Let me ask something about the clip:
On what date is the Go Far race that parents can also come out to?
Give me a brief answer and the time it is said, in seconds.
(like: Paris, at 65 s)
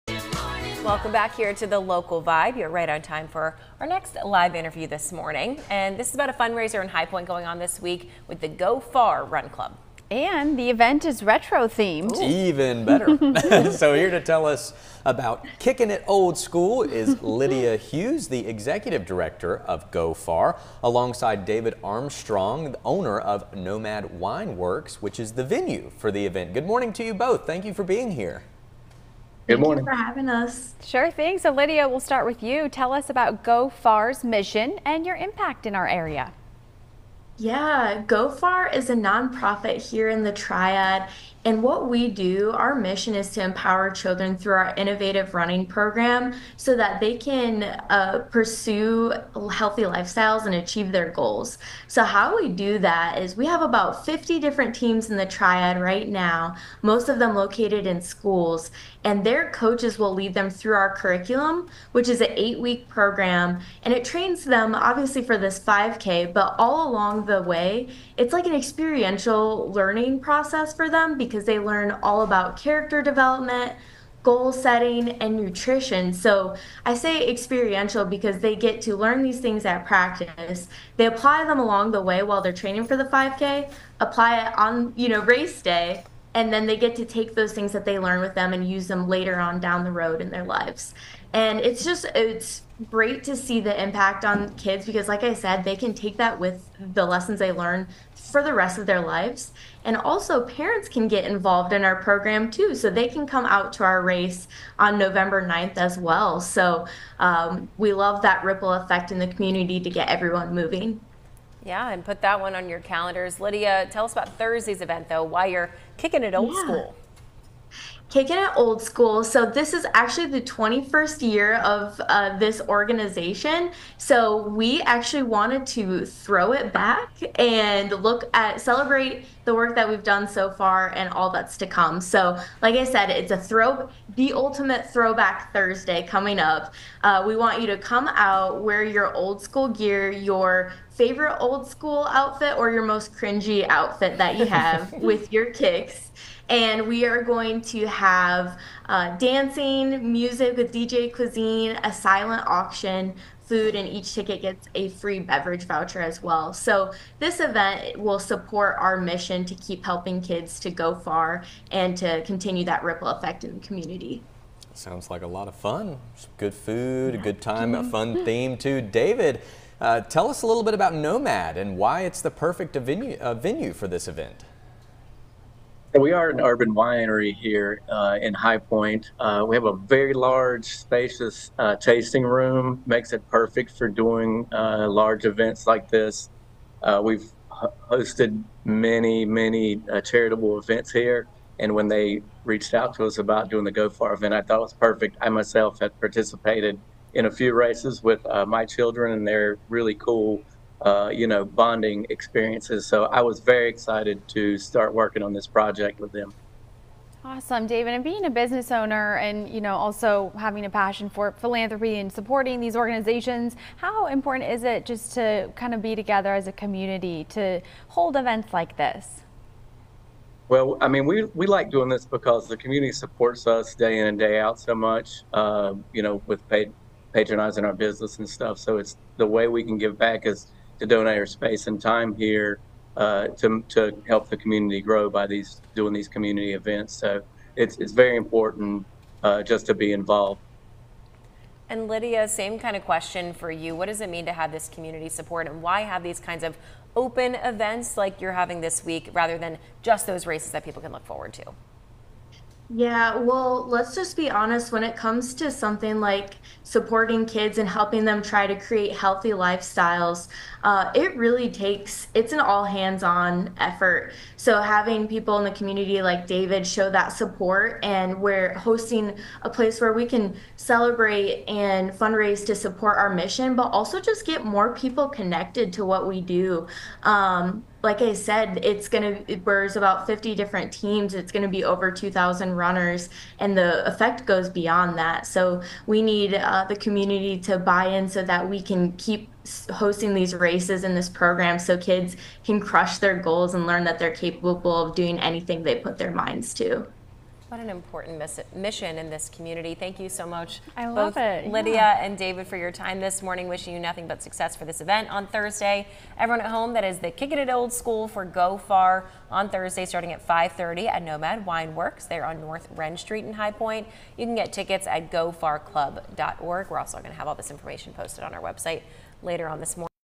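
November 9, at 104 s.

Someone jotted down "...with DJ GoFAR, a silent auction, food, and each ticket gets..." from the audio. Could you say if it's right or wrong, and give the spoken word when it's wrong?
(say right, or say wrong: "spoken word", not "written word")
wrong: "Cuisine", not "GoFAR".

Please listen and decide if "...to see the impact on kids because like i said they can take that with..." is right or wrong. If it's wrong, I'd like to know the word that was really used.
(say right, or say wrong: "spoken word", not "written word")
right.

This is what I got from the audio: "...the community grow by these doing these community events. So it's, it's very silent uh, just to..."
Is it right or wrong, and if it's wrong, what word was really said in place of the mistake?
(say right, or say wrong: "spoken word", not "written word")
wrong: "important", not "silent".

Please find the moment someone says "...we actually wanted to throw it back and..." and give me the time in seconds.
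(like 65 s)
124 s.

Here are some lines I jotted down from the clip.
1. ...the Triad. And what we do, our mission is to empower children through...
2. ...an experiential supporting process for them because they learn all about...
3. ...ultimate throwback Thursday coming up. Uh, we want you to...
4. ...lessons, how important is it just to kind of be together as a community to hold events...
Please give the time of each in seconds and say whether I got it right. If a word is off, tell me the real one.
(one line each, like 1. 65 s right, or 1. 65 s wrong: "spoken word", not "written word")
1. 40 s right
2. 68 s wrong: "learning", not "supporting"
3. 134 s right
4. 212 s wrong: "organizations", not "lessons".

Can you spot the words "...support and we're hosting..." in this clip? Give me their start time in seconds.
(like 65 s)
267 s.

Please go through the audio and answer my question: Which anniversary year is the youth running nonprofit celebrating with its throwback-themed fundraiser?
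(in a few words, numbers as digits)
21st.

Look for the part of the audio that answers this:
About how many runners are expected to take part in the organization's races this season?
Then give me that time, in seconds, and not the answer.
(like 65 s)
281 s.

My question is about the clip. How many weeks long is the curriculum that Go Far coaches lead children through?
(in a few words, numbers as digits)
8.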